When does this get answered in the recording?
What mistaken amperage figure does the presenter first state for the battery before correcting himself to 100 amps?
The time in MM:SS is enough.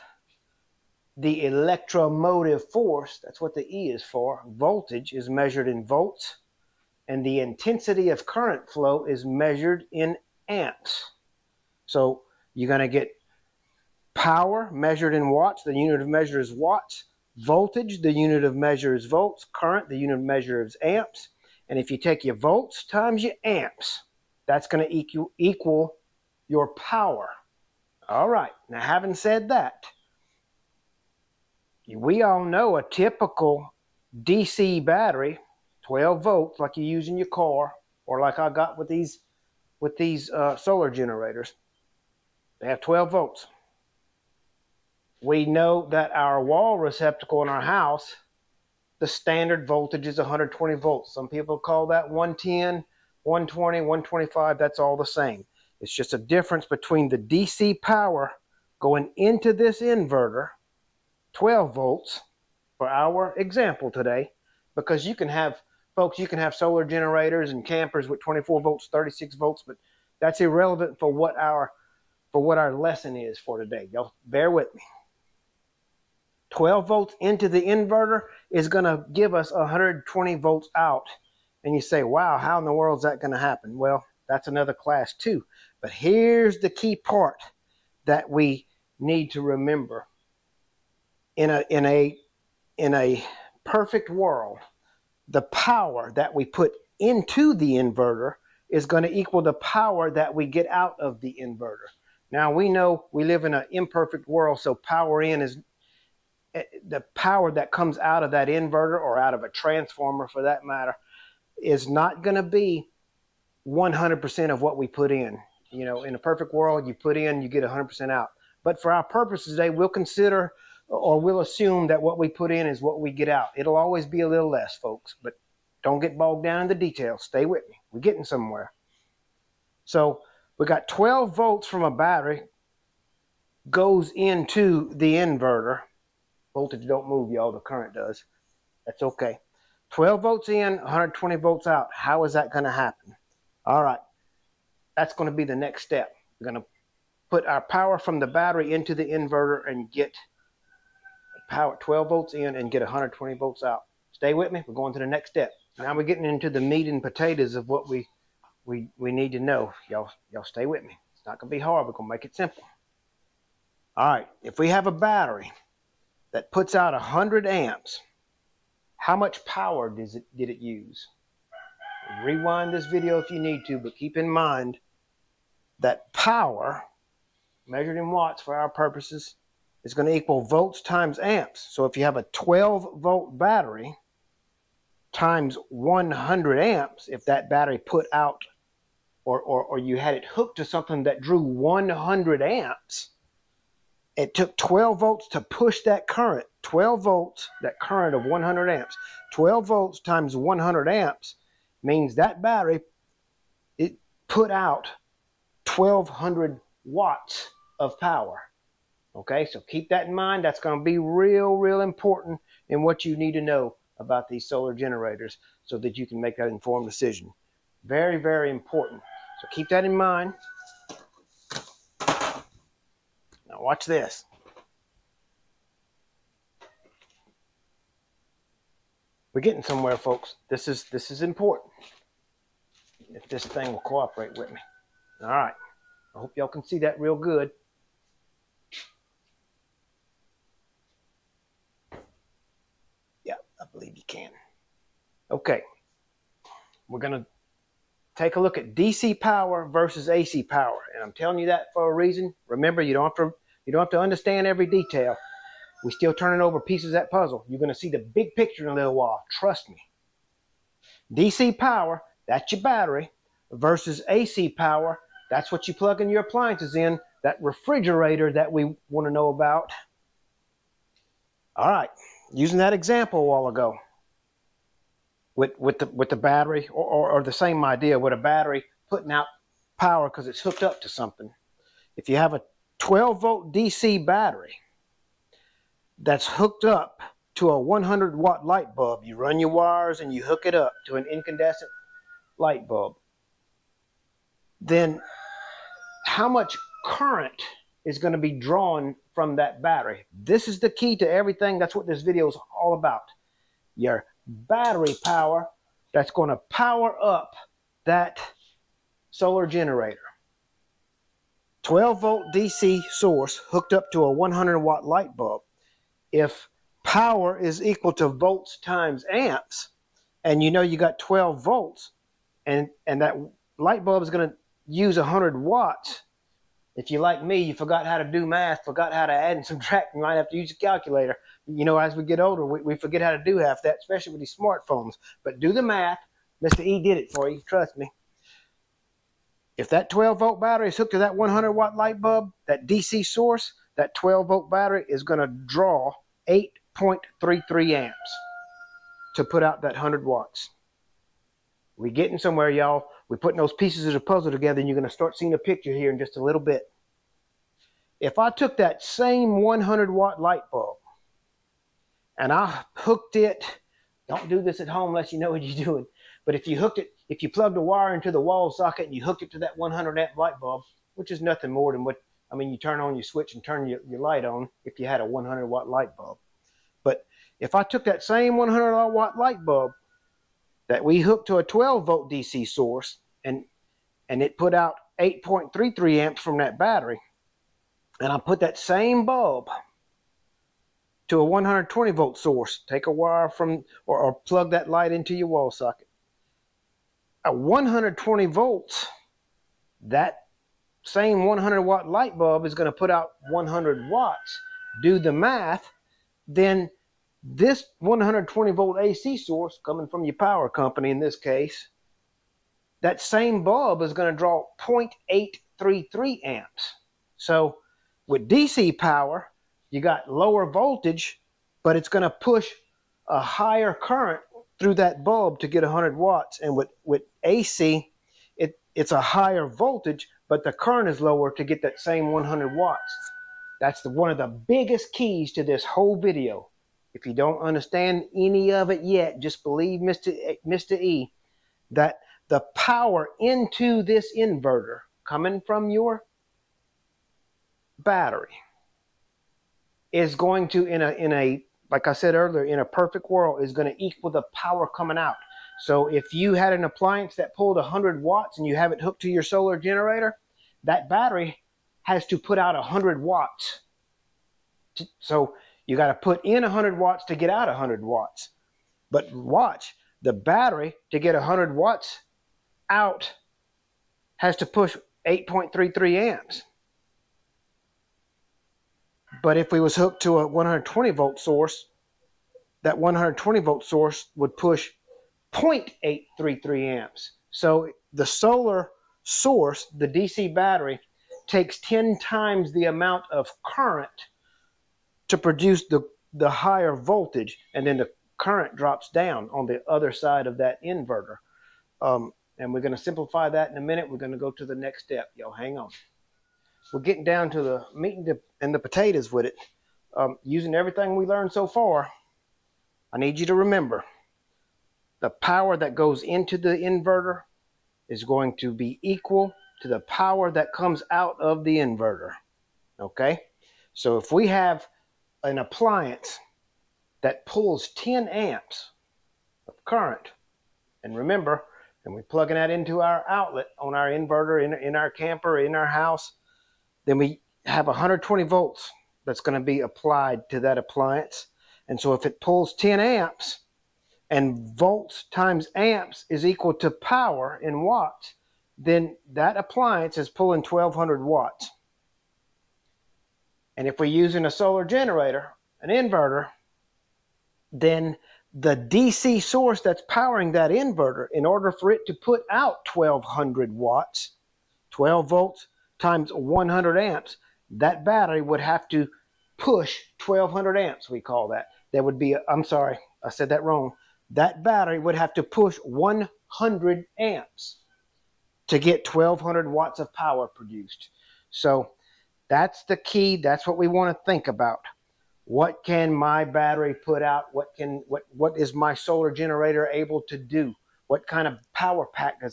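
09:30.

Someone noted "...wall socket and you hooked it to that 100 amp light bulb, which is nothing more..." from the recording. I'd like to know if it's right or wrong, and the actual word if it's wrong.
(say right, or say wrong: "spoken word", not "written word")
right.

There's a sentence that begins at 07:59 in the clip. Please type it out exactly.
But if we was hooked to a 120 volt source, that 120 volt source would push 0.833 amps.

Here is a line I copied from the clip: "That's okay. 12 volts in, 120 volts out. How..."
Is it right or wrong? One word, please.
right.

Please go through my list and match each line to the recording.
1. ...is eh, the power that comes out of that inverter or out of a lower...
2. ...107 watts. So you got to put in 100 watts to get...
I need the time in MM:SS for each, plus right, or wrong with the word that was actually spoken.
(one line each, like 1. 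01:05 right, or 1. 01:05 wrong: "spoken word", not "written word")
1. 01:45 wrong: "transformer", not "lower"
2. 07:42 wrong: "100", not "107".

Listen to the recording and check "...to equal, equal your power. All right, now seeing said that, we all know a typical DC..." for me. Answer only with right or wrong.
wrong.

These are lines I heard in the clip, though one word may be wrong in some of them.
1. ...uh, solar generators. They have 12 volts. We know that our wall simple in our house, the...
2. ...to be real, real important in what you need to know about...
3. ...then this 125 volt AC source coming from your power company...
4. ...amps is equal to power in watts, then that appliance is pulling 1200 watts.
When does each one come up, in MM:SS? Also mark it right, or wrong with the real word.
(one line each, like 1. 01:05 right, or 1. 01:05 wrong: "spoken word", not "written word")
1. 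00:40 wrong: "receptacle", not "simple"
2. 03:30 right
3. 06:46 wrong: "120", not "125"
4. 09:05 right.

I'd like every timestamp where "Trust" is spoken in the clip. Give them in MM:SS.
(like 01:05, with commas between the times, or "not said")
04:19, 05:37.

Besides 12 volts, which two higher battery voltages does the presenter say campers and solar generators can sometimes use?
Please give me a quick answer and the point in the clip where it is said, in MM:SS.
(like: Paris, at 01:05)
24 volts, 36 volts, at 01:08.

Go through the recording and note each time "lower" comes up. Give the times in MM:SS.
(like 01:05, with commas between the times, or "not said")
07:00, 07:10.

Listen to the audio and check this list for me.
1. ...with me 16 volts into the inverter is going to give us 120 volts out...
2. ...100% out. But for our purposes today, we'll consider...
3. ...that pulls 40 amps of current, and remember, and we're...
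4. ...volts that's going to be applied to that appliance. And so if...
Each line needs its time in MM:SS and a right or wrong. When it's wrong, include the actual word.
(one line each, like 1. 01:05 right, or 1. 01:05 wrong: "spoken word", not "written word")
1. 01:14 wrong: "12", not "16"
2. 01:57 right
3. 08:47 wrong: "10", not "40"
4. 08:58 right.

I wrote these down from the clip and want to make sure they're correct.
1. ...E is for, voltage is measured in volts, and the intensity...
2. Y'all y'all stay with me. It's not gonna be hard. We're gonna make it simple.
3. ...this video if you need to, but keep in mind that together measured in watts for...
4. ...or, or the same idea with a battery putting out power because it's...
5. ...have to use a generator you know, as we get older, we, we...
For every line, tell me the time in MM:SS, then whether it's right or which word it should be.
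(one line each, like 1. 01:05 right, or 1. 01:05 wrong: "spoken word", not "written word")
1. 00:03 right
2. 02:39 right
3. 02:52 wrong: "power", not "together"
4. 04:36 right
5. 05:30 wrong: "calculator", not "generator".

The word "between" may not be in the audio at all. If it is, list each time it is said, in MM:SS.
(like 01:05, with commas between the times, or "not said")
00:56.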